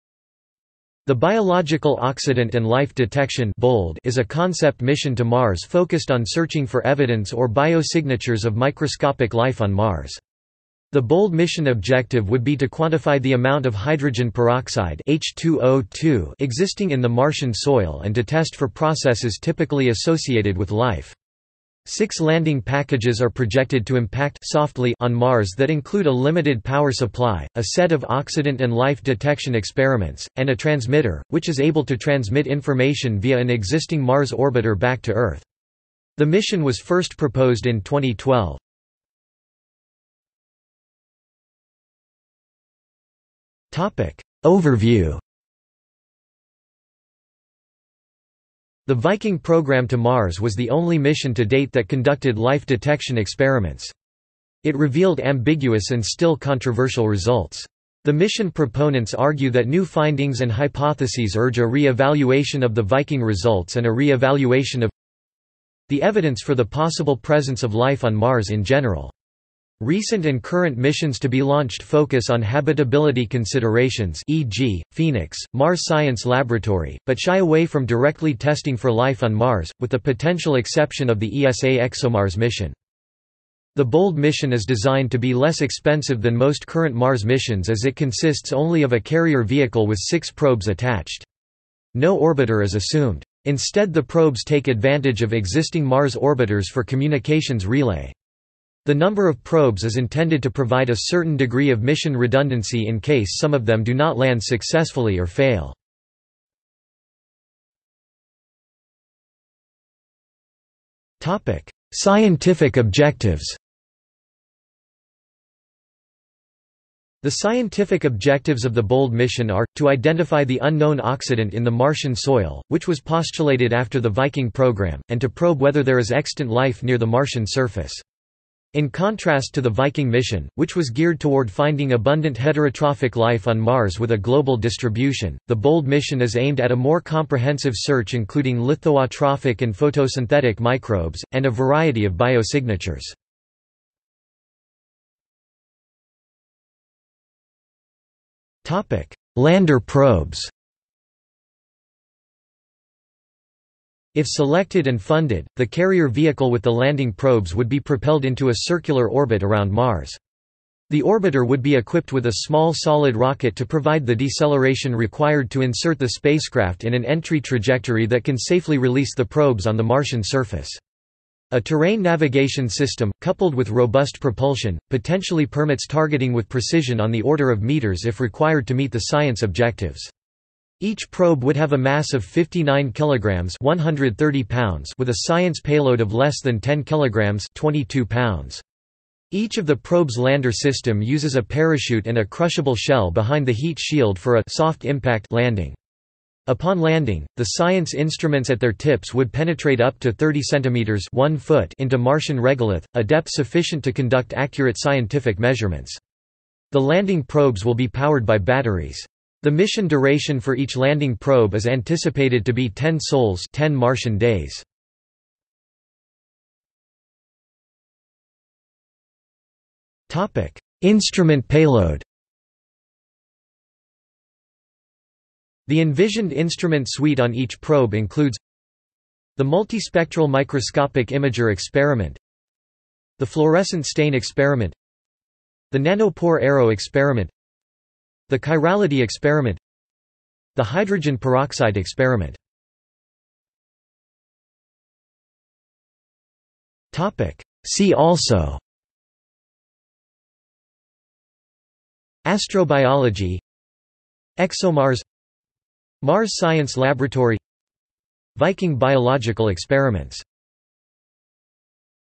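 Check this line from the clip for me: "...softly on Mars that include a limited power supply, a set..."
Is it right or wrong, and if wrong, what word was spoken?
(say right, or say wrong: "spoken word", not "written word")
right.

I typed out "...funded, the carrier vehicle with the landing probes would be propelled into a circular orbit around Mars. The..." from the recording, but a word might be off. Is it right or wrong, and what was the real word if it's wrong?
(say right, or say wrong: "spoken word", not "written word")
right.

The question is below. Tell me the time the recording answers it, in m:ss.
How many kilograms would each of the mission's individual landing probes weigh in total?
3:02.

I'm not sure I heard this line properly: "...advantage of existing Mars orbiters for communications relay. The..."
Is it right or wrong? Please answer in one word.
right.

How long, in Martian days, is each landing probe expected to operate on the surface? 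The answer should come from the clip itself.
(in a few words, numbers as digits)
10 sols.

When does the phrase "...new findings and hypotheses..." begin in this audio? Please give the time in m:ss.
0:59.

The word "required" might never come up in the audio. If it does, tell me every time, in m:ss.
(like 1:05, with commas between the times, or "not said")
2:44, 2:58.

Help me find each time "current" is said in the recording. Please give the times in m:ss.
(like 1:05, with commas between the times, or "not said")
1:10, 1:26.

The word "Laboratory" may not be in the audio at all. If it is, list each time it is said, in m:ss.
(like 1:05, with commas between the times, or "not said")
1:16, 4:16.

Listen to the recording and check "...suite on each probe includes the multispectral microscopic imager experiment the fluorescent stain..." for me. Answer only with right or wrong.
right.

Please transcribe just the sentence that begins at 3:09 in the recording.
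Each of the probe's lander system uses a parachute and a crushable shell behind the heat shield for a soft impact landing.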